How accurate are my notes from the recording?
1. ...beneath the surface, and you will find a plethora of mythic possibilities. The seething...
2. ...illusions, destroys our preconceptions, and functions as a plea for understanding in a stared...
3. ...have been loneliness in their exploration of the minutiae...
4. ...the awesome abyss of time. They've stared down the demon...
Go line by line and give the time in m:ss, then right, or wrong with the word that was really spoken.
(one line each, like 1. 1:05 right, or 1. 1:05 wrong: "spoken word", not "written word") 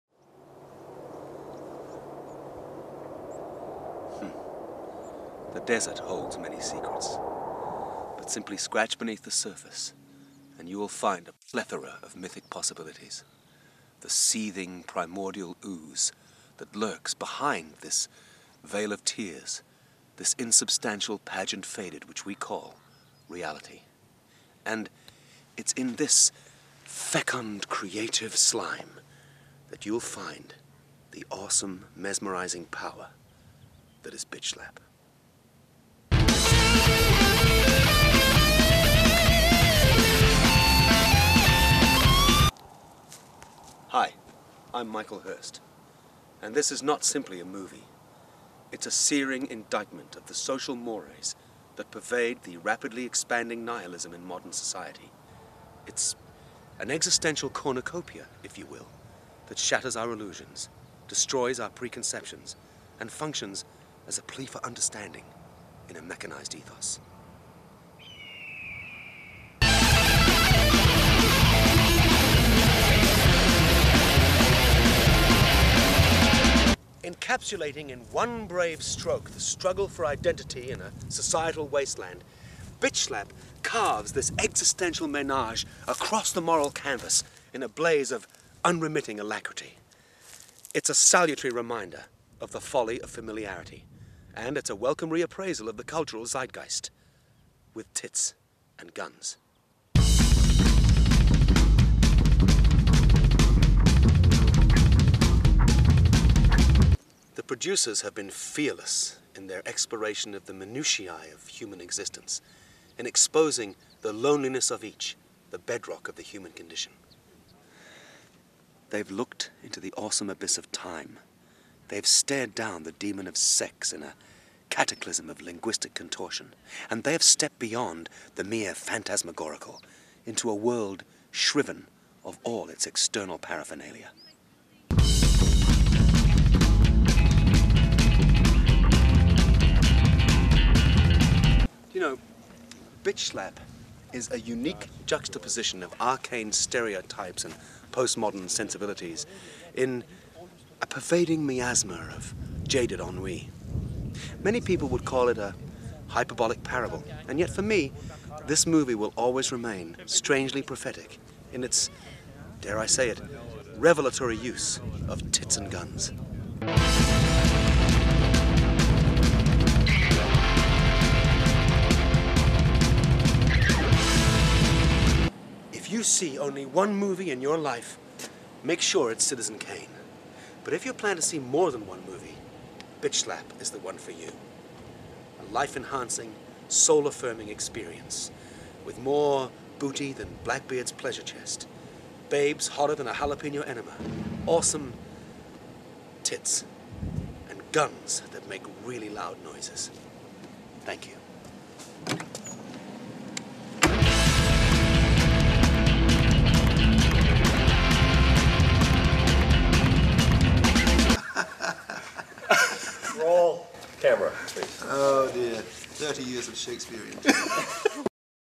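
1. 0:08 right
2. 1:00 wrong: "mechanized", not "stared"
3. 1:48 wrong: "fearless", not "loneliness"
4. 1:59 right.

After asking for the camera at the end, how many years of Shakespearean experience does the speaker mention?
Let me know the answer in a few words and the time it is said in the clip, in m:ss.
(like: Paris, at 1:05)
30, at 3:35.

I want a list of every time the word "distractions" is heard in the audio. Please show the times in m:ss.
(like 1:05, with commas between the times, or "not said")
not said.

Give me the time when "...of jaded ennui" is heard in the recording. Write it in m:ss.
2:32.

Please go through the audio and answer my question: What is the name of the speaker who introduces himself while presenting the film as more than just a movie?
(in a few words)
Michael Hurst.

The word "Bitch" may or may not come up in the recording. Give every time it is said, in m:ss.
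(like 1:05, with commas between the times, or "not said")
0:34, 1:22, 2:23, 3:03.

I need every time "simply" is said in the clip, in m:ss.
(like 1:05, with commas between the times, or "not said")
0:08, 0:47.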